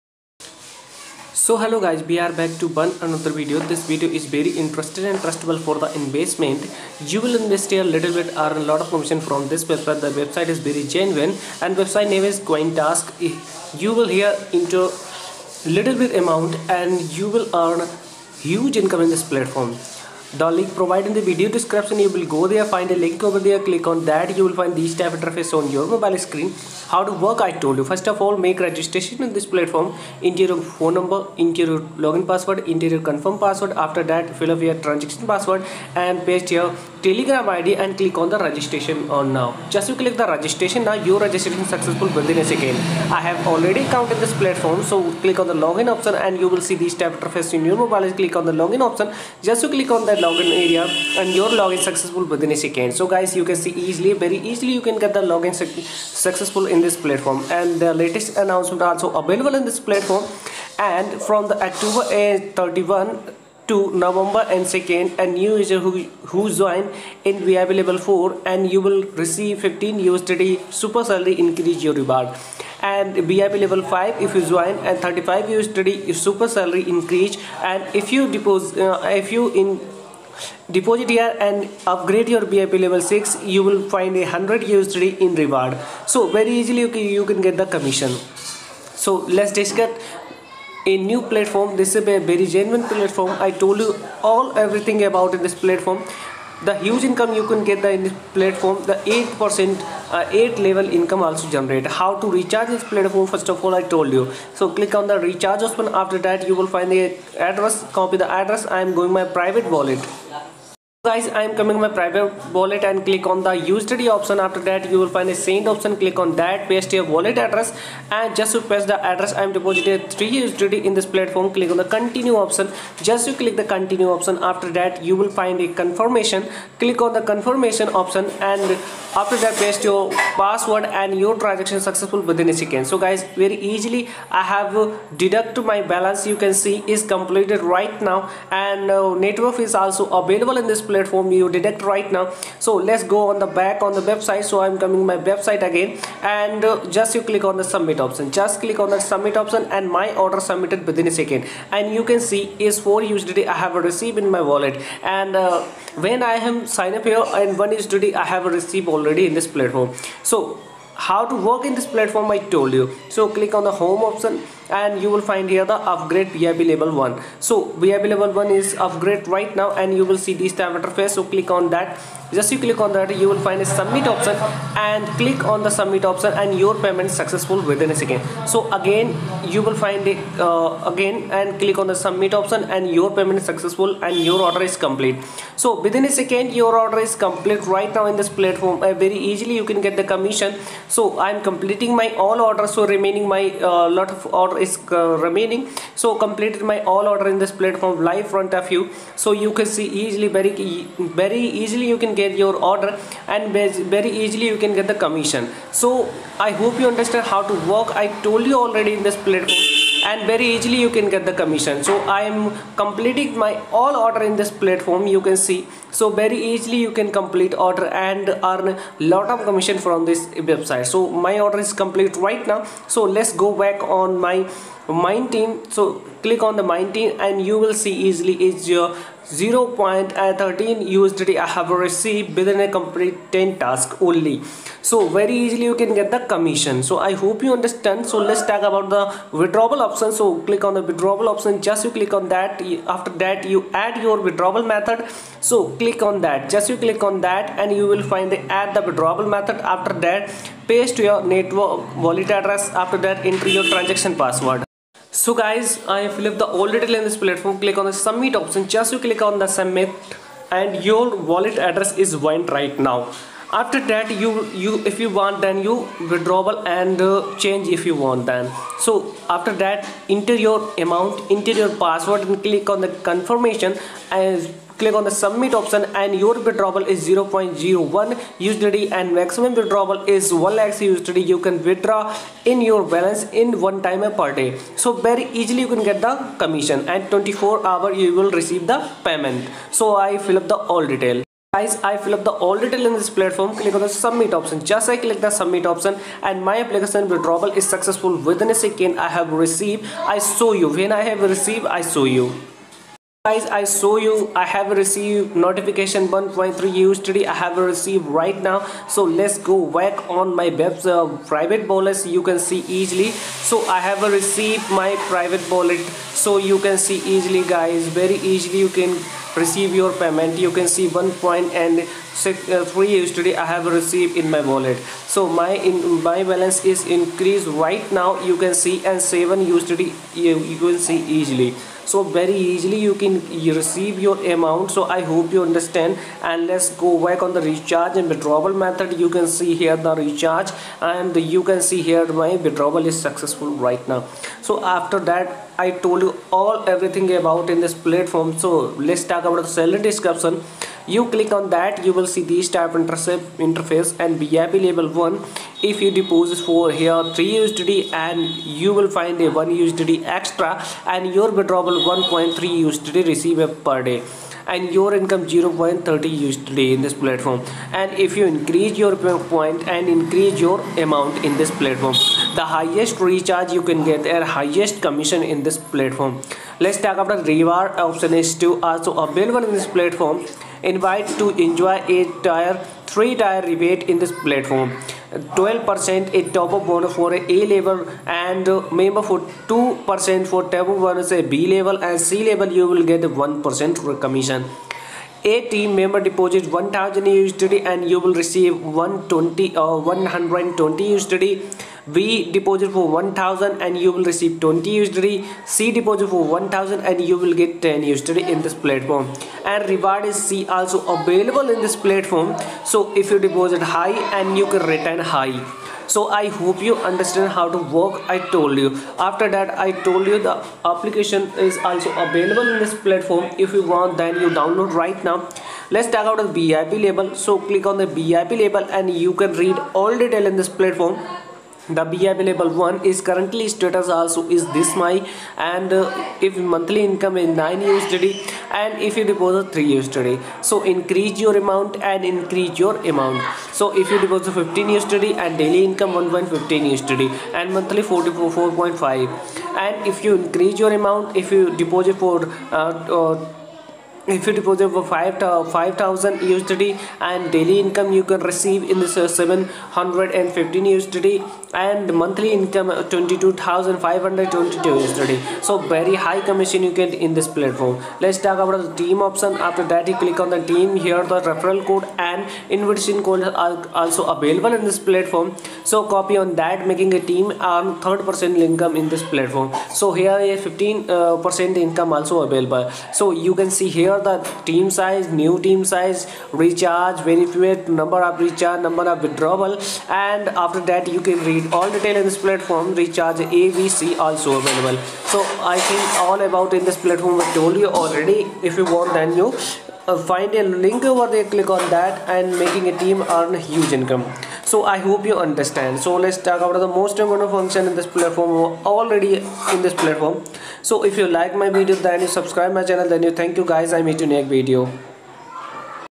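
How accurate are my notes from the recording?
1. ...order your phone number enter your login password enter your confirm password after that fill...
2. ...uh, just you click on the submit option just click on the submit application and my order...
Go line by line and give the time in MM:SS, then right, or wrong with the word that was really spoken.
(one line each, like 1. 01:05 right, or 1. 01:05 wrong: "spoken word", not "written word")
1. 00:30 wrong: "enter", not "order"
2. 02:26 wrong: "option", not "application".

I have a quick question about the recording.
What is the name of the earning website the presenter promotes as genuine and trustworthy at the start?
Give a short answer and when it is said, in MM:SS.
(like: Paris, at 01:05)
Queen Task, at 00:12.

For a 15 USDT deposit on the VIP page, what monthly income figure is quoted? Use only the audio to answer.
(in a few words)
44.5.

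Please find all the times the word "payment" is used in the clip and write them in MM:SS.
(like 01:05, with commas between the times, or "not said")
02:56, 03:03, 04:49, 05:19.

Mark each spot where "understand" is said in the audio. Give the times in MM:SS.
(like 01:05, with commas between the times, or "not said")
03:26, 03:57, 05:35, 06:56, 08:25.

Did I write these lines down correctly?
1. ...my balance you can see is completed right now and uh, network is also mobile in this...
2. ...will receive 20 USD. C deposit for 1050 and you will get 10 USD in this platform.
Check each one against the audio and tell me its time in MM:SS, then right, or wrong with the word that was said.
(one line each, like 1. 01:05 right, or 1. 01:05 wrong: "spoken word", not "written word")
1. 02:15 wrong: "available", not "mobile"
2. 06:43 wrong: "1000", not "1050".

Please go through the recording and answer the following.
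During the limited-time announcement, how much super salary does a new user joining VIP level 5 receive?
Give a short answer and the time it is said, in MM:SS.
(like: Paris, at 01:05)
35 USD, at 01:15.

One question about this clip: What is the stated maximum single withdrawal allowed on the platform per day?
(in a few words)
1 lakh USD.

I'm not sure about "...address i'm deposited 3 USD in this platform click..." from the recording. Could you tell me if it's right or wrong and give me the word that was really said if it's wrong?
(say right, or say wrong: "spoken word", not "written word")
right.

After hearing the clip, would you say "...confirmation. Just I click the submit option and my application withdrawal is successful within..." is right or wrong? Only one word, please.
wrong.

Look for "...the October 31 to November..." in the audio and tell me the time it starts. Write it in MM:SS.
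01:01.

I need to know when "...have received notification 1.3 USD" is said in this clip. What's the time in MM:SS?
05:04.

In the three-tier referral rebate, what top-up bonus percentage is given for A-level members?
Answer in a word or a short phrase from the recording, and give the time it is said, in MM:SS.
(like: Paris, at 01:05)
12%, at 06:25.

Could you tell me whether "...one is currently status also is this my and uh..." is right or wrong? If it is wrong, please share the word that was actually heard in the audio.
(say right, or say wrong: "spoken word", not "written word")
right.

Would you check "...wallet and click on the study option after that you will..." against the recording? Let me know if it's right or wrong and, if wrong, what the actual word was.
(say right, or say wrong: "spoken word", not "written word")
right.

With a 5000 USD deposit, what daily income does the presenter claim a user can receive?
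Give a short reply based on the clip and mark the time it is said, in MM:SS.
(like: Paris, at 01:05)
715 USD, at 07:39.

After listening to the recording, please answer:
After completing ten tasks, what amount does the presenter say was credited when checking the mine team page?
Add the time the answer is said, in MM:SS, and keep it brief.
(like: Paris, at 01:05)
0.13 USDT, at 03:49.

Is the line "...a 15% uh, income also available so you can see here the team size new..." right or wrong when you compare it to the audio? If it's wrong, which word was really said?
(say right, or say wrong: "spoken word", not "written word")
right.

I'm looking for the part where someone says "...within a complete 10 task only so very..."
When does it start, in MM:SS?
03:52.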